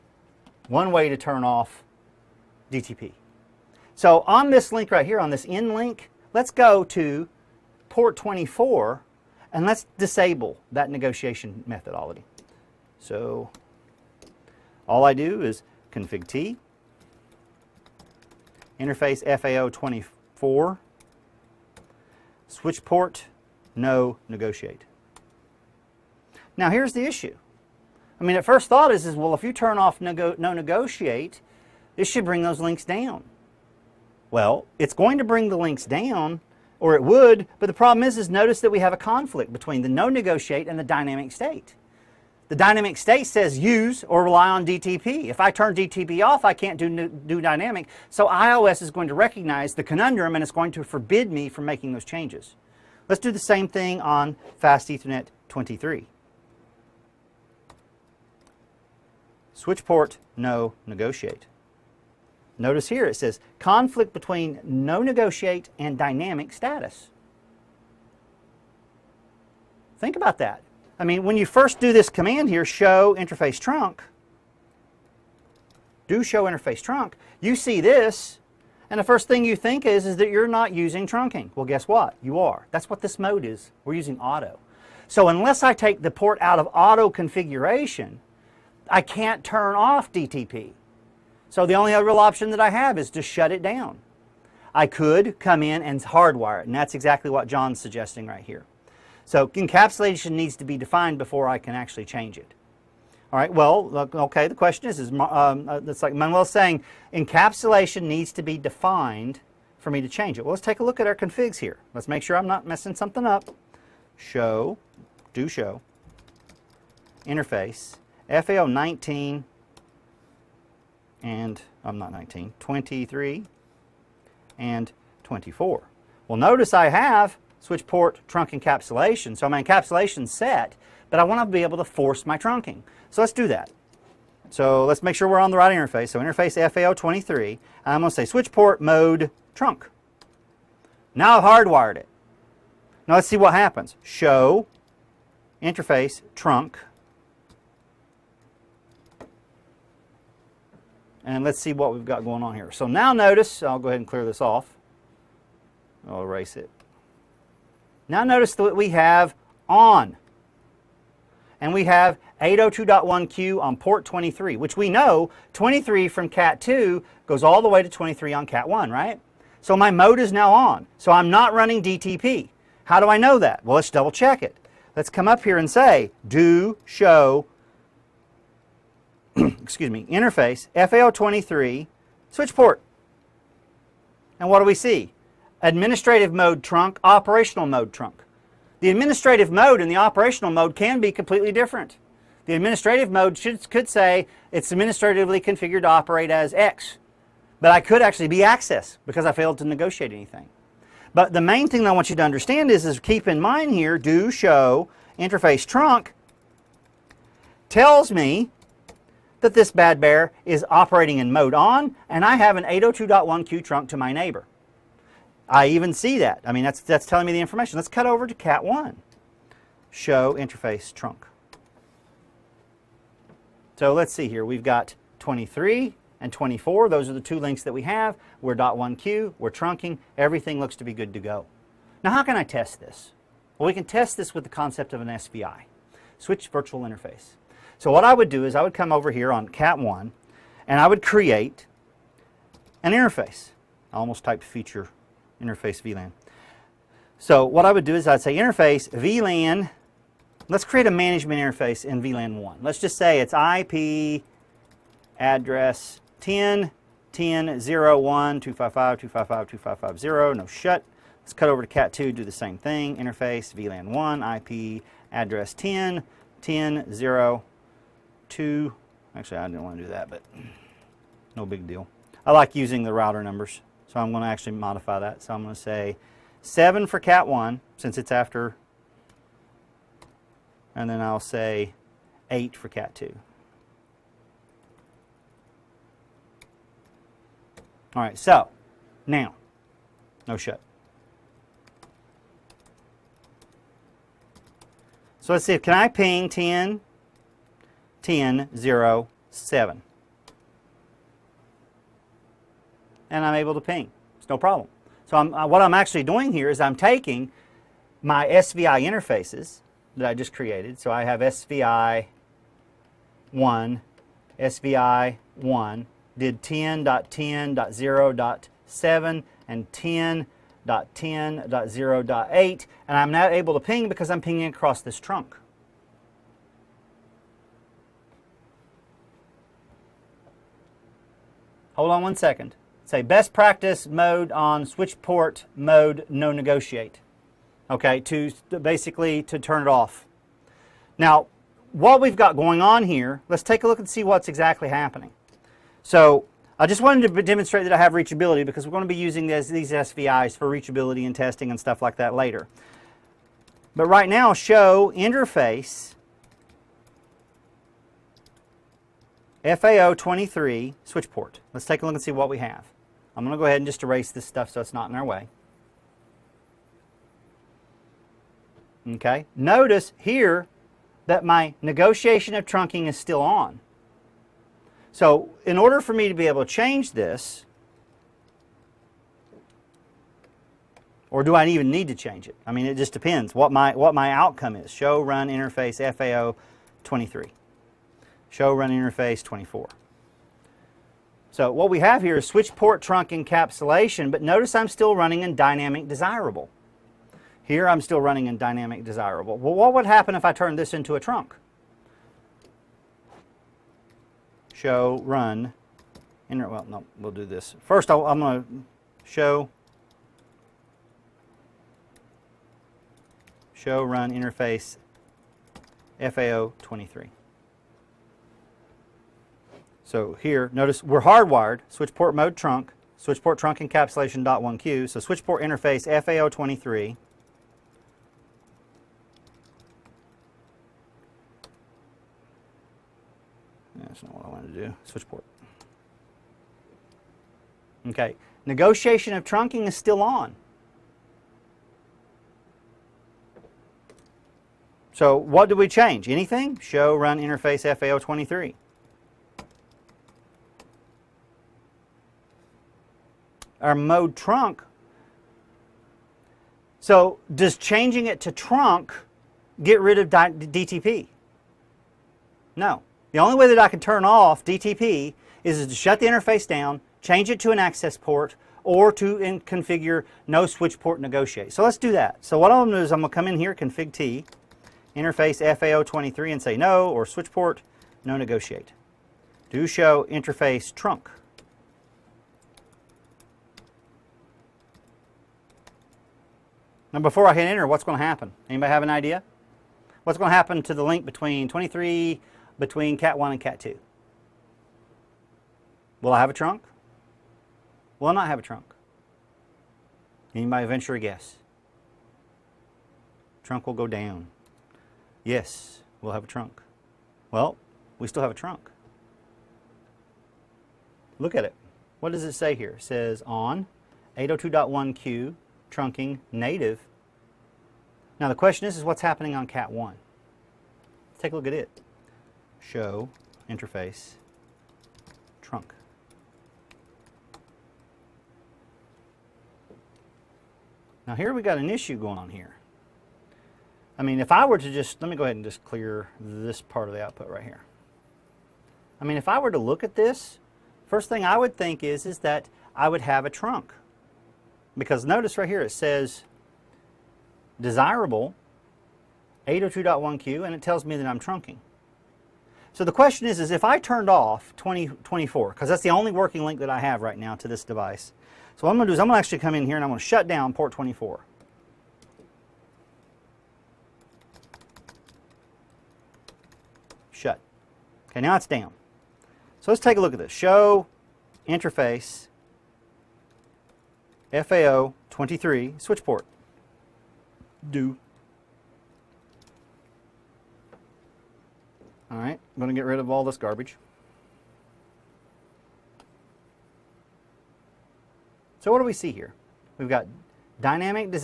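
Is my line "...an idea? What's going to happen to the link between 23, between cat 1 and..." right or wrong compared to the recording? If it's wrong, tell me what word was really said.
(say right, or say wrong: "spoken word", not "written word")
right.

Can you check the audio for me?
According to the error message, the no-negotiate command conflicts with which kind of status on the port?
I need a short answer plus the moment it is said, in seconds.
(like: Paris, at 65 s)
dynamic status, at 65 s.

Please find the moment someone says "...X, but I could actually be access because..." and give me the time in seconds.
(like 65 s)
196 s.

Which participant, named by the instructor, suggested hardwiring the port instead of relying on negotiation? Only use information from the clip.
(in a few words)
John.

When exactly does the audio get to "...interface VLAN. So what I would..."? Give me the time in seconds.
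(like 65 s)
245 s.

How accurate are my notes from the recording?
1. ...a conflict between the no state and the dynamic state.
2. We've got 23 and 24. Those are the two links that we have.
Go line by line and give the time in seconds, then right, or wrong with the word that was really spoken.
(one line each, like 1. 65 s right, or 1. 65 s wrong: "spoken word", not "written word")
1. 38 s wrong: "negotiate", not "state"
2. 224 s right.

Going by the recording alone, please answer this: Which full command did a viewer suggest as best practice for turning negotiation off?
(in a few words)
switch port mode no negotiate.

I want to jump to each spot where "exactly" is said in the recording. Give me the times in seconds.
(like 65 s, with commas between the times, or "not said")
96 s, 344 s.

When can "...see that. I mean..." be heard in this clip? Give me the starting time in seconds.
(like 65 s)
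215 s.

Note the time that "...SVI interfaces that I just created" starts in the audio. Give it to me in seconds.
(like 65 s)
308 s.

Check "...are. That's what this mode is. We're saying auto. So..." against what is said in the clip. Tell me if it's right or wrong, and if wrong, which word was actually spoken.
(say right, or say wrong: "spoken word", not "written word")
wrong: "using", not "saying".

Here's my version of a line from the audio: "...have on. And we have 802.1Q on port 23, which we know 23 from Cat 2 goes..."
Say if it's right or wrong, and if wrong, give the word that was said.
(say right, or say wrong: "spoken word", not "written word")
right.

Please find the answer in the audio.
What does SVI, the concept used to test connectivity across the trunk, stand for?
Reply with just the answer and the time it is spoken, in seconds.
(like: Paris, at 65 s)
Switch Virtual Interface, at 236 s.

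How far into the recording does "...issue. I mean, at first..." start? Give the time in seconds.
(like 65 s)
27 s.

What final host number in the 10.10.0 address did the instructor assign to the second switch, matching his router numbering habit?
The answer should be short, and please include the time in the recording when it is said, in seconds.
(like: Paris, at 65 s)
8, at 282 s.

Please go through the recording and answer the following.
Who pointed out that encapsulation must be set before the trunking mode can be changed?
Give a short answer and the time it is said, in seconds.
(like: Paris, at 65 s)
Manuel, at 106 s.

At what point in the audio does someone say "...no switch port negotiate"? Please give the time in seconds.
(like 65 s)
470 s.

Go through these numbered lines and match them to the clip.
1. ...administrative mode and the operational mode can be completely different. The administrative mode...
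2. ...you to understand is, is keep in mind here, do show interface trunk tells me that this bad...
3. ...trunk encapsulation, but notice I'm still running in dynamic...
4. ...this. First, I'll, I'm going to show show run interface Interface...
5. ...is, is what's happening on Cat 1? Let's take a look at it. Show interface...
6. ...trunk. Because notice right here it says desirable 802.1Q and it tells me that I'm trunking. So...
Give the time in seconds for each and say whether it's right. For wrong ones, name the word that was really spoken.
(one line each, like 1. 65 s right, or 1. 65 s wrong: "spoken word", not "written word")
1. 188 s right
2. 202 s right
3. 392 s right
4. 407 s wrong: "FAO", not "Interface"
5. 518 s right
6. 543 s right.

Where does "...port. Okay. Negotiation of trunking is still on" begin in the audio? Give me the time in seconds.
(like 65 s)
435 s.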